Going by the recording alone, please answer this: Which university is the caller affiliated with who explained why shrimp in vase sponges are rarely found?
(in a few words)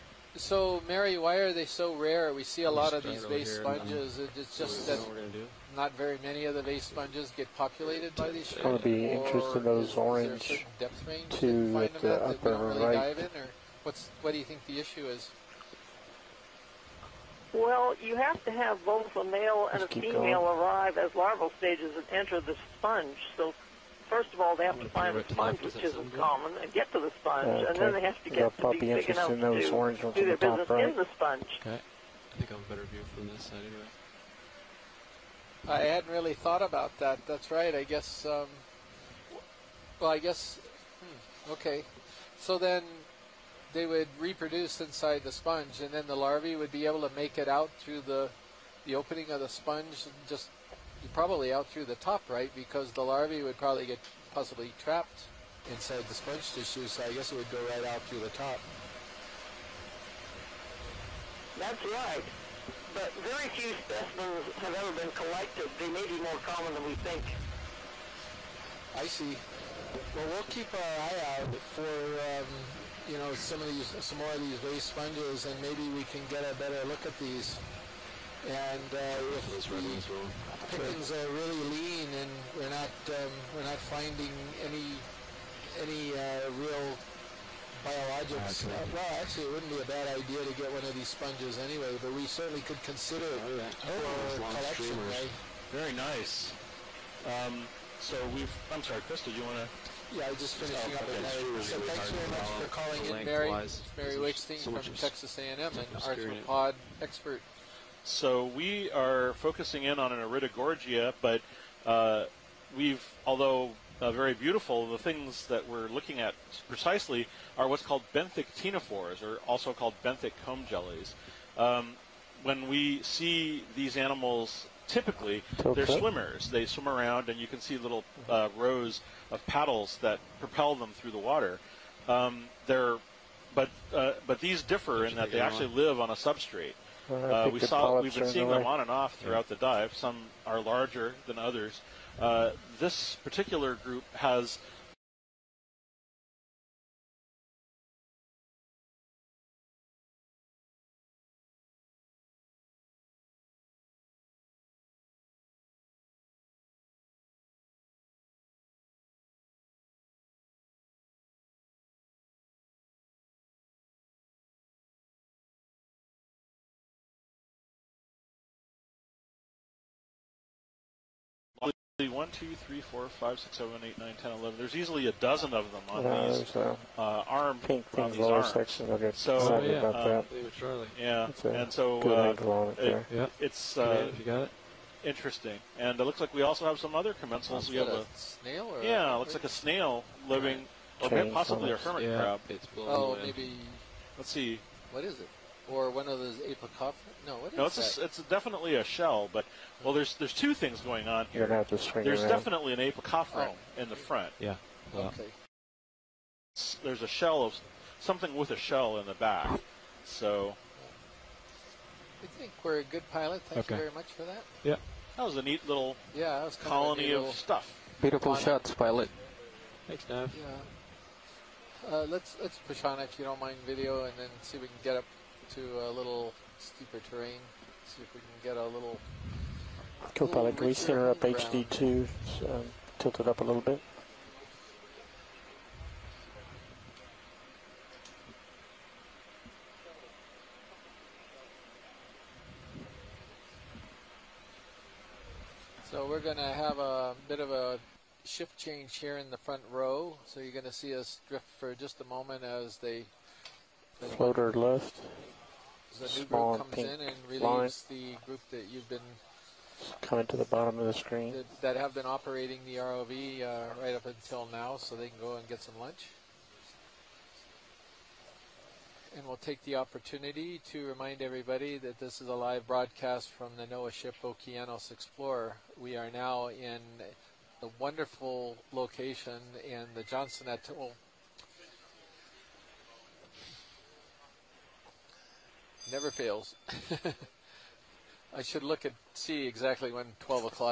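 Texas A&M.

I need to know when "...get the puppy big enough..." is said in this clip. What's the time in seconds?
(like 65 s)
28 s.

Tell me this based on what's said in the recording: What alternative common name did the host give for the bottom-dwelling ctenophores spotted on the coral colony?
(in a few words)
benthic comb jellies.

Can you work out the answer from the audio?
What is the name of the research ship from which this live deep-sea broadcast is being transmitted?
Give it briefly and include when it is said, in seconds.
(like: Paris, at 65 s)
Okeanos Explorer, at 274 s.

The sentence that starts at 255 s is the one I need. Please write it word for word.
The new Small group comes in and relieves line.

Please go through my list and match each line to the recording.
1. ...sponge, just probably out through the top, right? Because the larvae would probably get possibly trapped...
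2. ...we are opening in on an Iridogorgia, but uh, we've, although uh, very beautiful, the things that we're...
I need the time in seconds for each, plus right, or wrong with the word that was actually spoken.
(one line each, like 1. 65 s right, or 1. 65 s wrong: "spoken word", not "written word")
1. 49 s right
2. 108 s wrong: "focusing", not "opening".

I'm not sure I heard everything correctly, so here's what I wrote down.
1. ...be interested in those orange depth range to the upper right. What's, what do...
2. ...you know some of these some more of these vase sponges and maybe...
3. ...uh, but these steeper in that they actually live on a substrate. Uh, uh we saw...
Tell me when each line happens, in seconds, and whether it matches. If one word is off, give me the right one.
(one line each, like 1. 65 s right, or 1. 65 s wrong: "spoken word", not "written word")
1. 8 s right
2. 73 s right
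3. 133 s wrong: "differ", not "steeper".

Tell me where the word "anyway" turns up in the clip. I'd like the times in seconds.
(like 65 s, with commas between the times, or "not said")
33 s, 91 s.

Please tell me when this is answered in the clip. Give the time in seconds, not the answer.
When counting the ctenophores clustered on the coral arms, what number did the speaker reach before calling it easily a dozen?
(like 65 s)
174 s.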